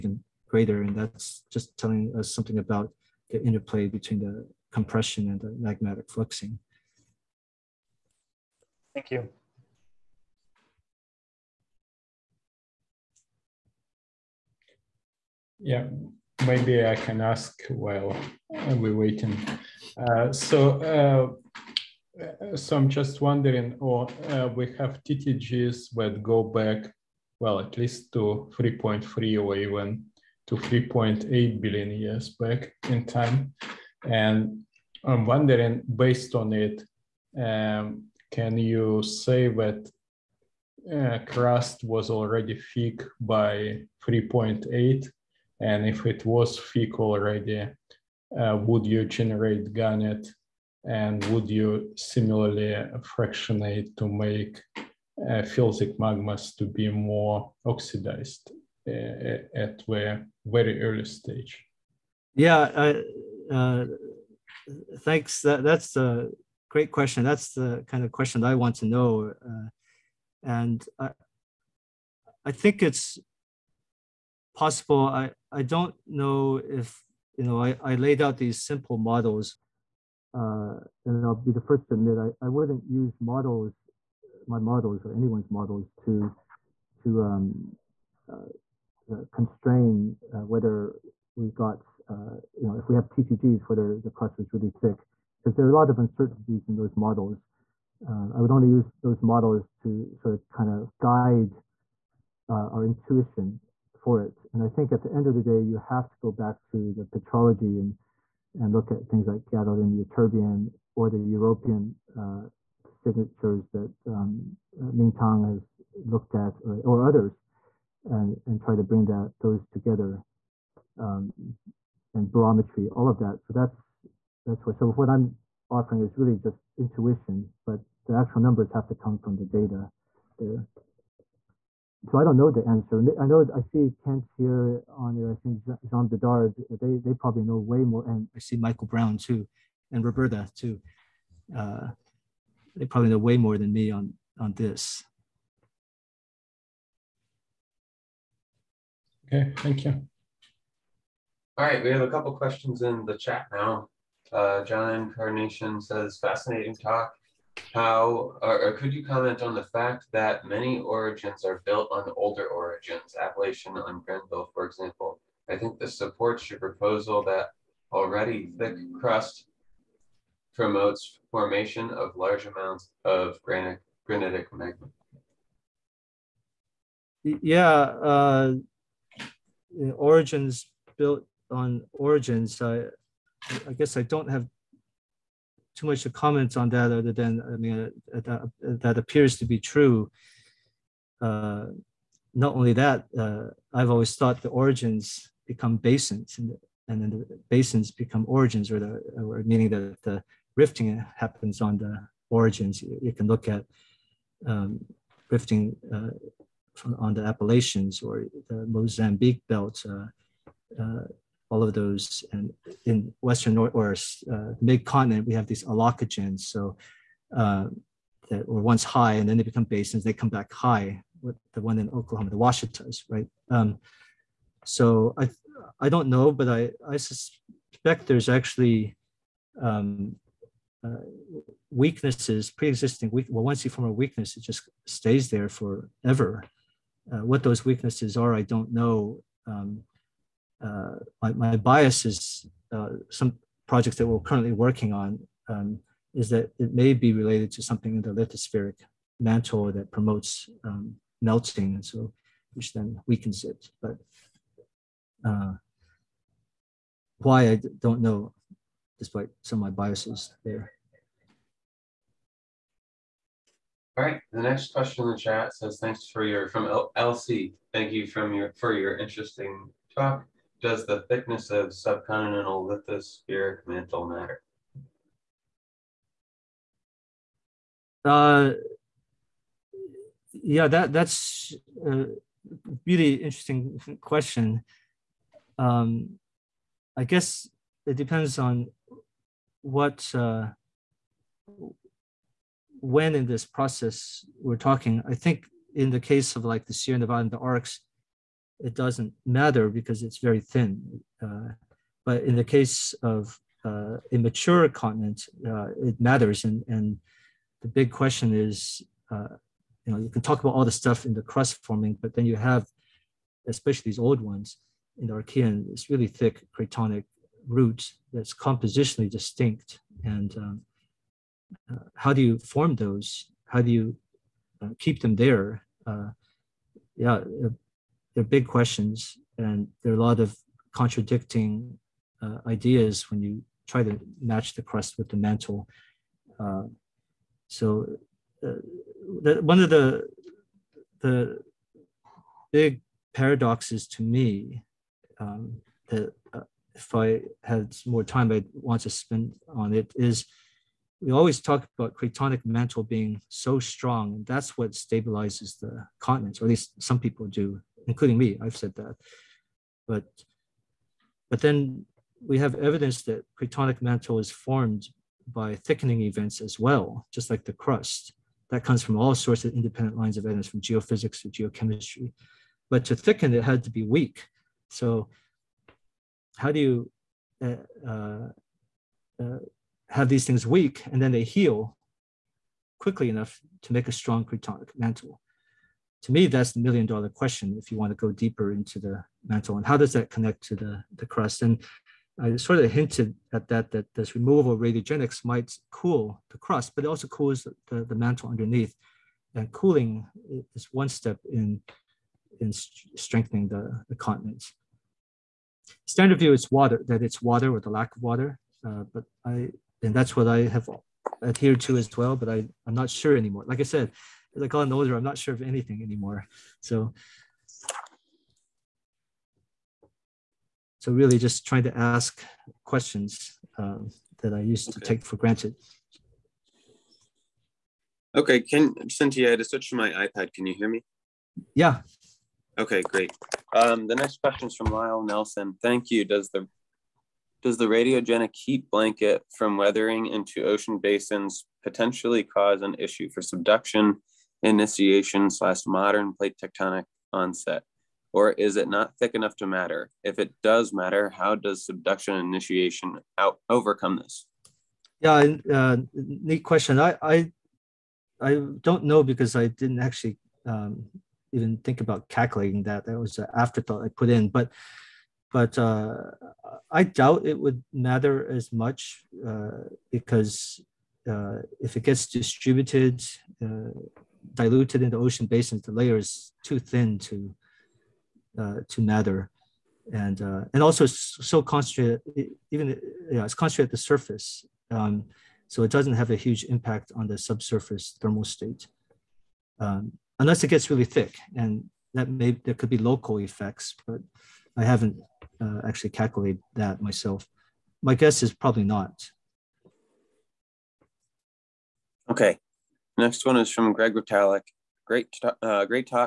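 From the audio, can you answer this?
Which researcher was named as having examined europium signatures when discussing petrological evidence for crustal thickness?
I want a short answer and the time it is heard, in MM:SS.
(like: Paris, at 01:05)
Ming Tang, at 01:54.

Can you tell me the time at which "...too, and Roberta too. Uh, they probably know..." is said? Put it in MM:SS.
02:19.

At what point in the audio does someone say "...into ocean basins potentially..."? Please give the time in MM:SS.
07:20.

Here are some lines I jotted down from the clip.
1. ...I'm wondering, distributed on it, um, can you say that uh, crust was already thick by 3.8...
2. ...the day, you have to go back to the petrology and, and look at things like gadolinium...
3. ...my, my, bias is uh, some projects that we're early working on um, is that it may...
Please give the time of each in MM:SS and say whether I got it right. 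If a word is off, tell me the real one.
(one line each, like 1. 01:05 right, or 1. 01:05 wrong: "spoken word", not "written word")
1. 00:35 wrong: "based", not "distributed"
2. 01:45 right
3. 04:01 wrong: "currently", not "early".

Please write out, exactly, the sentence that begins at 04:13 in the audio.
But uh, why I don't know, despite some of my biases there.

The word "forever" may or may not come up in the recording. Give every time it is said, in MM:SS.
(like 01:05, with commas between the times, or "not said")
03:55.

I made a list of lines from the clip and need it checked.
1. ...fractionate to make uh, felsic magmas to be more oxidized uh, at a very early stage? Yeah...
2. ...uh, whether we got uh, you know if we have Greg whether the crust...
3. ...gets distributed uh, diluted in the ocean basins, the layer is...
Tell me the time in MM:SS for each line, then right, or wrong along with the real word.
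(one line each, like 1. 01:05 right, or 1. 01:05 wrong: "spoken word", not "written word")
1. 00:53 right
2. 01:30 wrong: "TTGs", not "Greg"
3. 07:51 right.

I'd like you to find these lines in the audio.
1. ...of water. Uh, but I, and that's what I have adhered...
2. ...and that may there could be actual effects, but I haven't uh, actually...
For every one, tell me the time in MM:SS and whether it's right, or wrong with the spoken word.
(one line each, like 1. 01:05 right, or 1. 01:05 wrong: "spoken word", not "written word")
1. 06:47 right
2. 08:11 wrong: "local", not "actual".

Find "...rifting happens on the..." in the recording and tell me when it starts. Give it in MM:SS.
03:20.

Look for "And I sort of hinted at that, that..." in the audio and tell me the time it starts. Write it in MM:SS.
06:31.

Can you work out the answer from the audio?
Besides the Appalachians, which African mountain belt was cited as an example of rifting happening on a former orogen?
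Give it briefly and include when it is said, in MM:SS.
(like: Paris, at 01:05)
Mozambique belt, at 03:28.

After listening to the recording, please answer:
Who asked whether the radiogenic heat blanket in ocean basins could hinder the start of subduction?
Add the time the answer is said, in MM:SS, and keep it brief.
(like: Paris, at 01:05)
Lyle Nelson, at 07:14.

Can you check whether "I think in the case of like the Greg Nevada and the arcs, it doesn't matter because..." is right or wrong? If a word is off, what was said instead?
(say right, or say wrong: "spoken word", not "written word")
wrong: "Sierra", not "Greg".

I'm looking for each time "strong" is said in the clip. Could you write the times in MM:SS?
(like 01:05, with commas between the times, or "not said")
05:53, 06:23.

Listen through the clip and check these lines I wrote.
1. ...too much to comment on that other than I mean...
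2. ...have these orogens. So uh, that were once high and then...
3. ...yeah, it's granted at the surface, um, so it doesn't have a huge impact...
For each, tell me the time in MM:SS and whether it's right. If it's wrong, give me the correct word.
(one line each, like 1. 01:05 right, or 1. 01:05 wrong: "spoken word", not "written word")
1. 03:05 right
2. 03:35 wrong: "aulacogens", not "orogens"
3. 08:03 wrong: "concentrated", not "granted".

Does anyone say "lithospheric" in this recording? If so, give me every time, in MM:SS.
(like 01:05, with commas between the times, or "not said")
04:08, 04:32.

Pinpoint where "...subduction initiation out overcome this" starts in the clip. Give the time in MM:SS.
07:31.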